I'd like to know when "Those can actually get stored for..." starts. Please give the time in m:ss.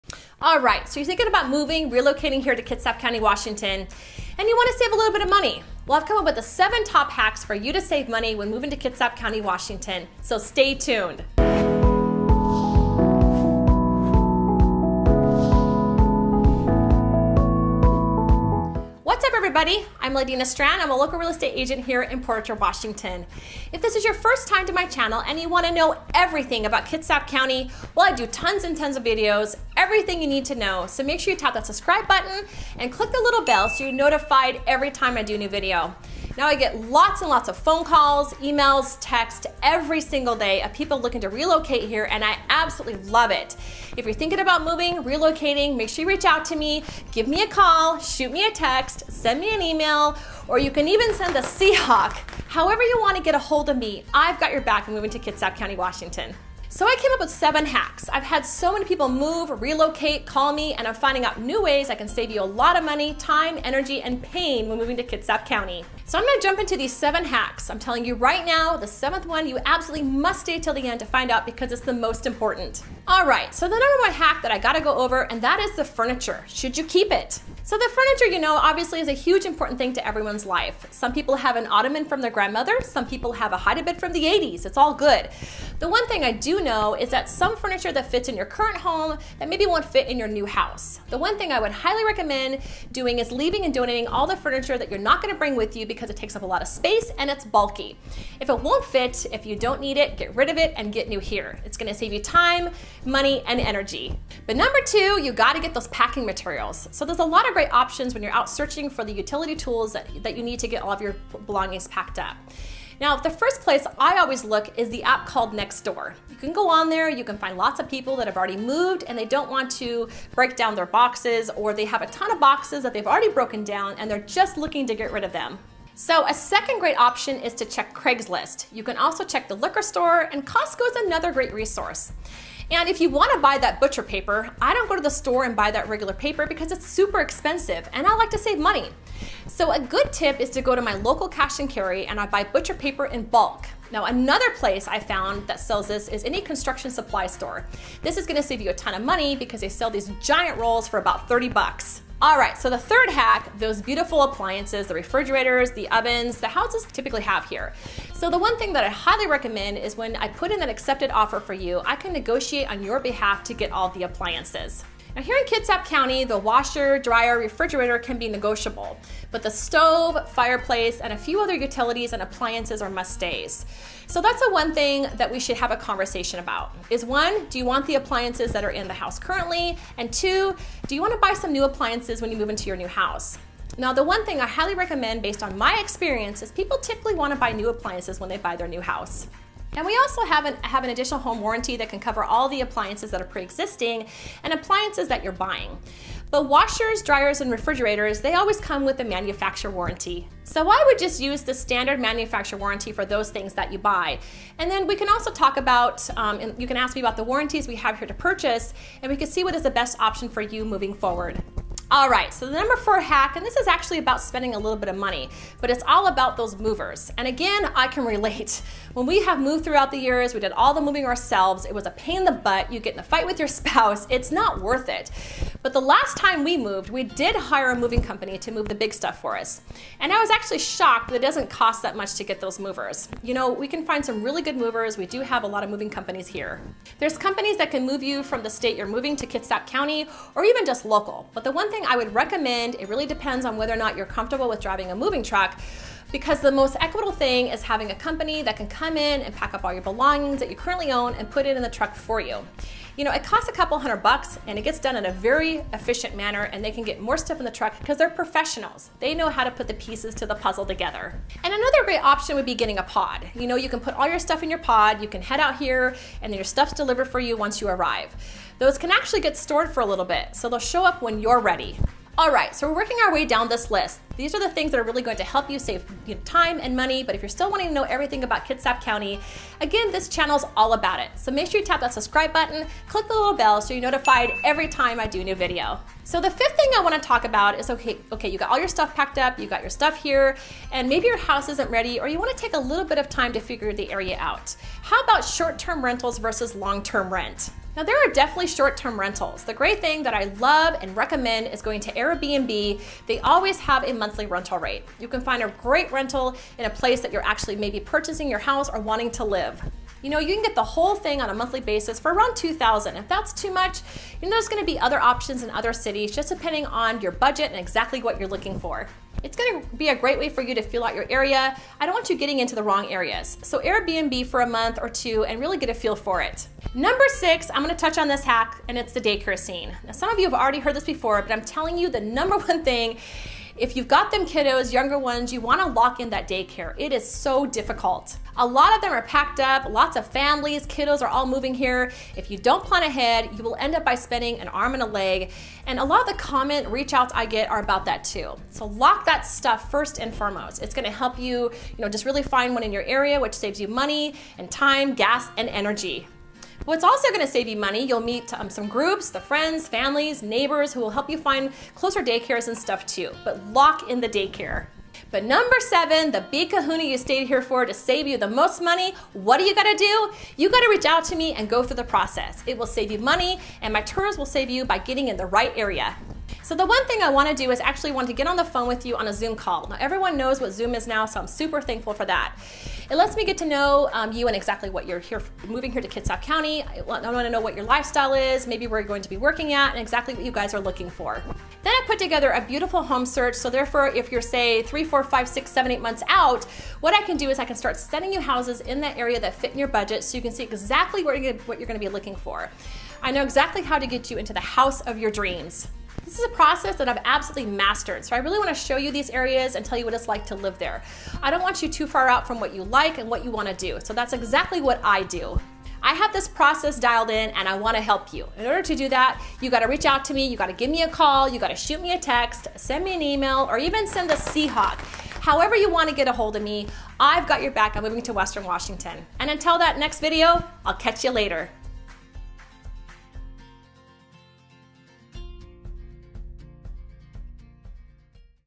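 4:28.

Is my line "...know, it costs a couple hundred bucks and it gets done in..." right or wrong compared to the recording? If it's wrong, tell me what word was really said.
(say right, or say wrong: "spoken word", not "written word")
right.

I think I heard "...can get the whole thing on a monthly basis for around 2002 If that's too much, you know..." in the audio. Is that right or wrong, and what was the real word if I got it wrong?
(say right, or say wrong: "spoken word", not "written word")
wrong: "2000", not "2002".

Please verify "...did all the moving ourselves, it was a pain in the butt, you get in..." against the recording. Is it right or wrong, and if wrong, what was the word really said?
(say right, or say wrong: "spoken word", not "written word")
right.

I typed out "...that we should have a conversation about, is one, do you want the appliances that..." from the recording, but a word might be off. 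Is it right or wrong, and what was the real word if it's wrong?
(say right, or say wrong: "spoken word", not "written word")
right.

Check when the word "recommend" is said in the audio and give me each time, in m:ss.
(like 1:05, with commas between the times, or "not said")
1:32, 2:39, 3:04, 4:02, 5:00.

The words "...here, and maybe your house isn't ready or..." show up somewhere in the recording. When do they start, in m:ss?
4:50.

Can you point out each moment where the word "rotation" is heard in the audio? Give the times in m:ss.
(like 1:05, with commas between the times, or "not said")
not said.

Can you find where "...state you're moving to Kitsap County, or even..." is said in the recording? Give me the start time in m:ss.
3:58.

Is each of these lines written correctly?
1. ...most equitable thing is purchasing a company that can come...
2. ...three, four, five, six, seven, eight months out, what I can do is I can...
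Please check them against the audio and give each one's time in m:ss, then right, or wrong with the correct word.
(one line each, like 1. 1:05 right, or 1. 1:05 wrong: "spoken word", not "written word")
1. 4:06 wrong: "having", not "purchasing"
2. 6:34 right.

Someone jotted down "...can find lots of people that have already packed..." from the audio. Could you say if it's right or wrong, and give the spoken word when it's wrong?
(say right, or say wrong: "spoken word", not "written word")
wrong: "moved", not "packed".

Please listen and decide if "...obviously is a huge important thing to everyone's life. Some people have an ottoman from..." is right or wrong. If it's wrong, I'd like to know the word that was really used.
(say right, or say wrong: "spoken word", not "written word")
right.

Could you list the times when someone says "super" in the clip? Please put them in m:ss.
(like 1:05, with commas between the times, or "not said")
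2:16, 6:21.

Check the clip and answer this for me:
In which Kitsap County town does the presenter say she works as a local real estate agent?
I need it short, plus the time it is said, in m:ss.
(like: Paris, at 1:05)
Port Orchard, at 0:22.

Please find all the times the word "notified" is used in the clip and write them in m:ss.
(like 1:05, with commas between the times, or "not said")
0:33, 4:43.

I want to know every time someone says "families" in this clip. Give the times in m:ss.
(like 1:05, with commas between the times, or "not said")
5:40, 5:59.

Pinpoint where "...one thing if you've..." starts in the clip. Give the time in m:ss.
5:32.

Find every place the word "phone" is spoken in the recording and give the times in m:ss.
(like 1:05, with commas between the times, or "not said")
0:37, 6:18.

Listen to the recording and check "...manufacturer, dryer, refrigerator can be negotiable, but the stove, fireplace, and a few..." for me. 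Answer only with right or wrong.
wrong.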